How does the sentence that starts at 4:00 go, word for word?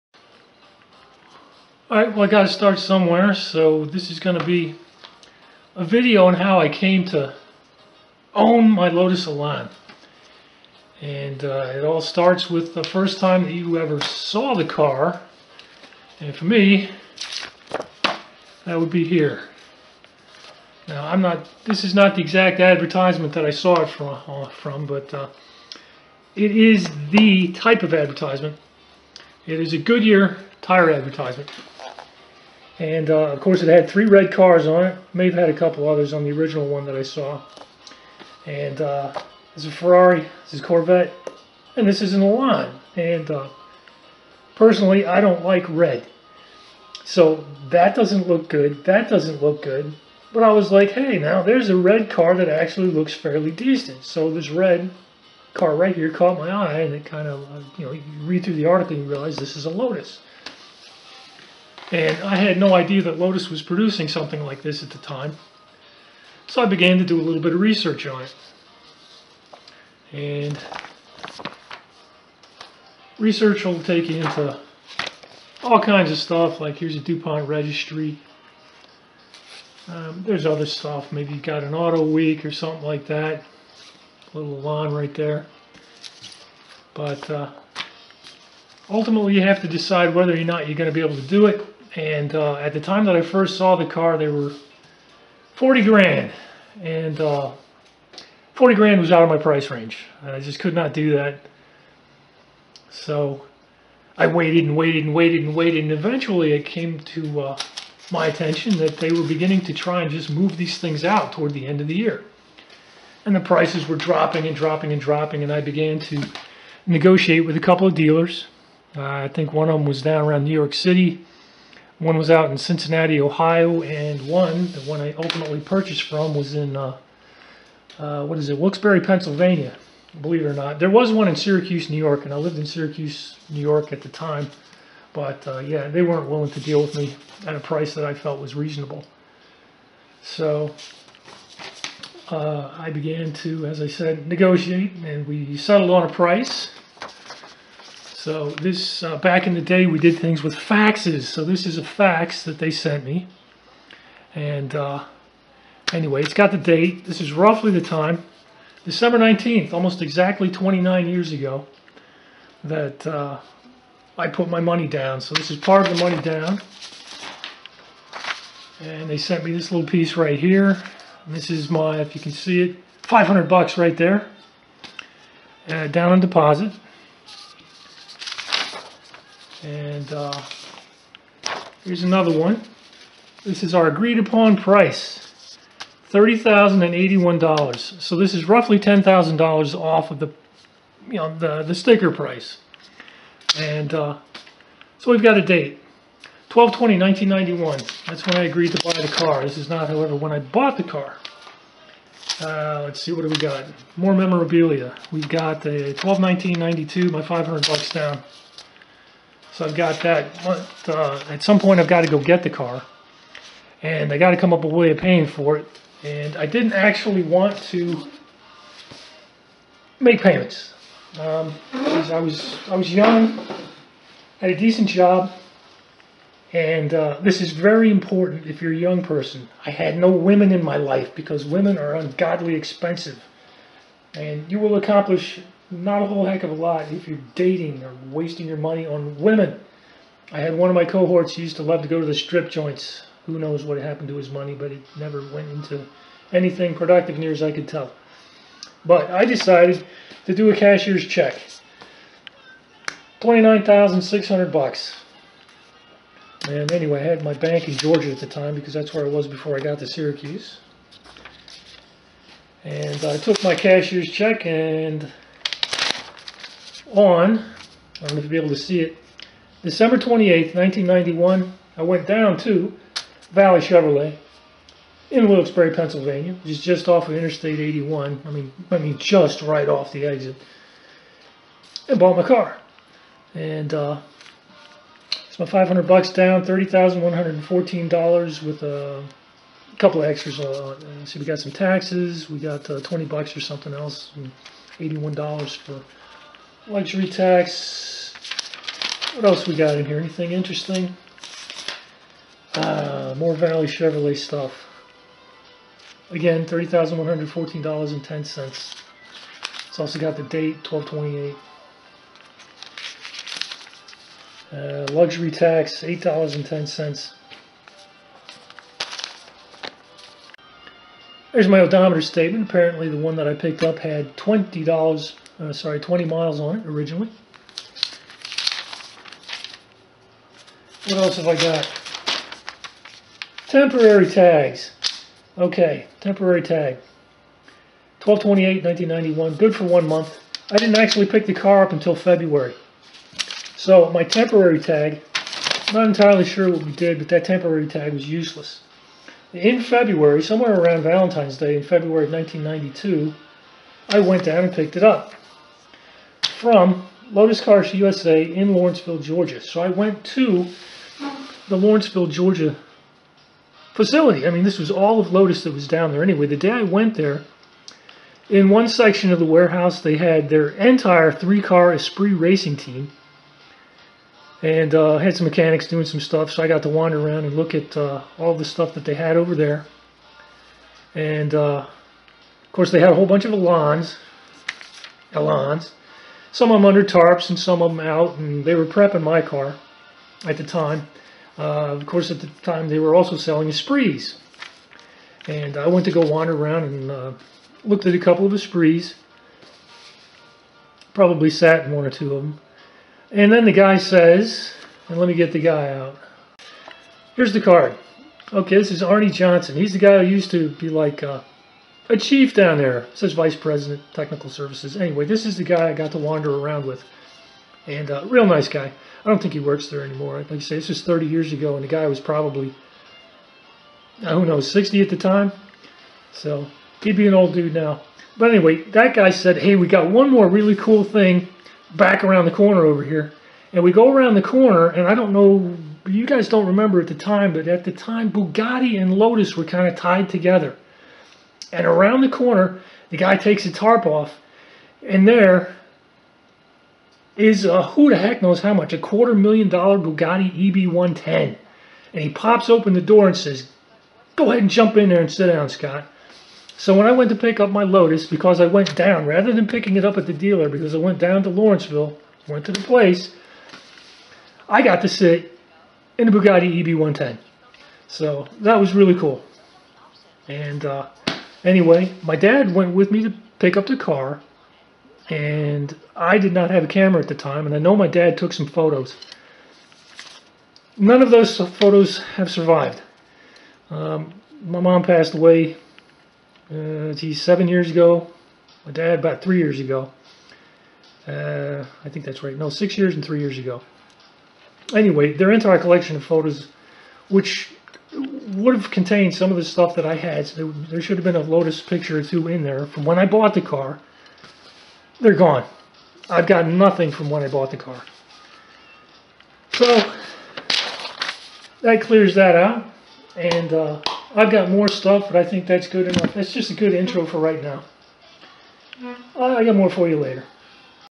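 I had one of my cohorts used to love to go to the strip joints.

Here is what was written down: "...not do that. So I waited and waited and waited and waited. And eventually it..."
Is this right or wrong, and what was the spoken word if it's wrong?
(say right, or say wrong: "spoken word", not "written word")
right.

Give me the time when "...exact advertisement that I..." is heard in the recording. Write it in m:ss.
0:22.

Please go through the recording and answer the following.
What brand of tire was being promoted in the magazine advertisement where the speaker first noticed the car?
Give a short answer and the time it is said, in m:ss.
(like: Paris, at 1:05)
Goodyear, at 0:29.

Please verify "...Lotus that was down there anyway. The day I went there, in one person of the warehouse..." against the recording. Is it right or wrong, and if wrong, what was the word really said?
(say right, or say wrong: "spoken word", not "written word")
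wrong: "section", not "person".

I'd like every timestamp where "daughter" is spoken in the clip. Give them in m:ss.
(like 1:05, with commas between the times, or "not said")
not said.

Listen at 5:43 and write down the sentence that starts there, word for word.
So my temporary tag, not entirely sure what we did, but that temporary tag was useless.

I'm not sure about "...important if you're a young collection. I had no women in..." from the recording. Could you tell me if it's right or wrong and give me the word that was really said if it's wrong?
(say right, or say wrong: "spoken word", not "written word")
wrong: "person", not "collection".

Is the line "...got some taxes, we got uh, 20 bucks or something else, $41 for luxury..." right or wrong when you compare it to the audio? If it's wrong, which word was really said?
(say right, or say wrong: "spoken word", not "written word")
wrong: "81", not "41".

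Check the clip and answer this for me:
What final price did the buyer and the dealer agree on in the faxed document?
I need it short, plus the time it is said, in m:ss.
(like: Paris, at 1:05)
$30,081, at 3:06.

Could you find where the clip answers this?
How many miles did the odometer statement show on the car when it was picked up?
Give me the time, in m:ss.
5:25.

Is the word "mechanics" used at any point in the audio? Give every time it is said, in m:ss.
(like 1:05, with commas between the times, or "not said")
6:15.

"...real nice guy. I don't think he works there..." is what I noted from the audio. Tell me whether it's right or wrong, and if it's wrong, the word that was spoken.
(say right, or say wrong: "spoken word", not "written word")
right.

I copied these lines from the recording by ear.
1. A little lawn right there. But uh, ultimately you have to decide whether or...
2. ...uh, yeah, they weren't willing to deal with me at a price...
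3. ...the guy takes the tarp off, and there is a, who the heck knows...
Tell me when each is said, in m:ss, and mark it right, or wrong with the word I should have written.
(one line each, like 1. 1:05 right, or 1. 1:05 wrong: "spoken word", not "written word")
1. 1:24 right
2. 2:15 right
3. 7:22 right.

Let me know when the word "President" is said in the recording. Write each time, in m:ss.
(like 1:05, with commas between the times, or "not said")
6:53.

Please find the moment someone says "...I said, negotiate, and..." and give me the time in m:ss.
2:23.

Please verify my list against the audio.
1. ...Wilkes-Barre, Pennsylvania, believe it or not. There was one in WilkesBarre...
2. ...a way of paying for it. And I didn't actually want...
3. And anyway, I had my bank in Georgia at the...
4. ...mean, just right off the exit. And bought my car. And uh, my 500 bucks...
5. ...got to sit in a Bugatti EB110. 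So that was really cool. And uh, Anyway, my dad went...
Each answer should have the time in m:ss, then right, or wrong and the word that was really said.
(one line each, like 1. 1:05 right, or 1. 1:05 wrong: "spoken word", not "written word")
1. 2:08 wrong: "Syracuse", not "WilkesBarre"
2. 3:34 right
3. 4:16 right
4. 4:38 right
5. 7:44 right.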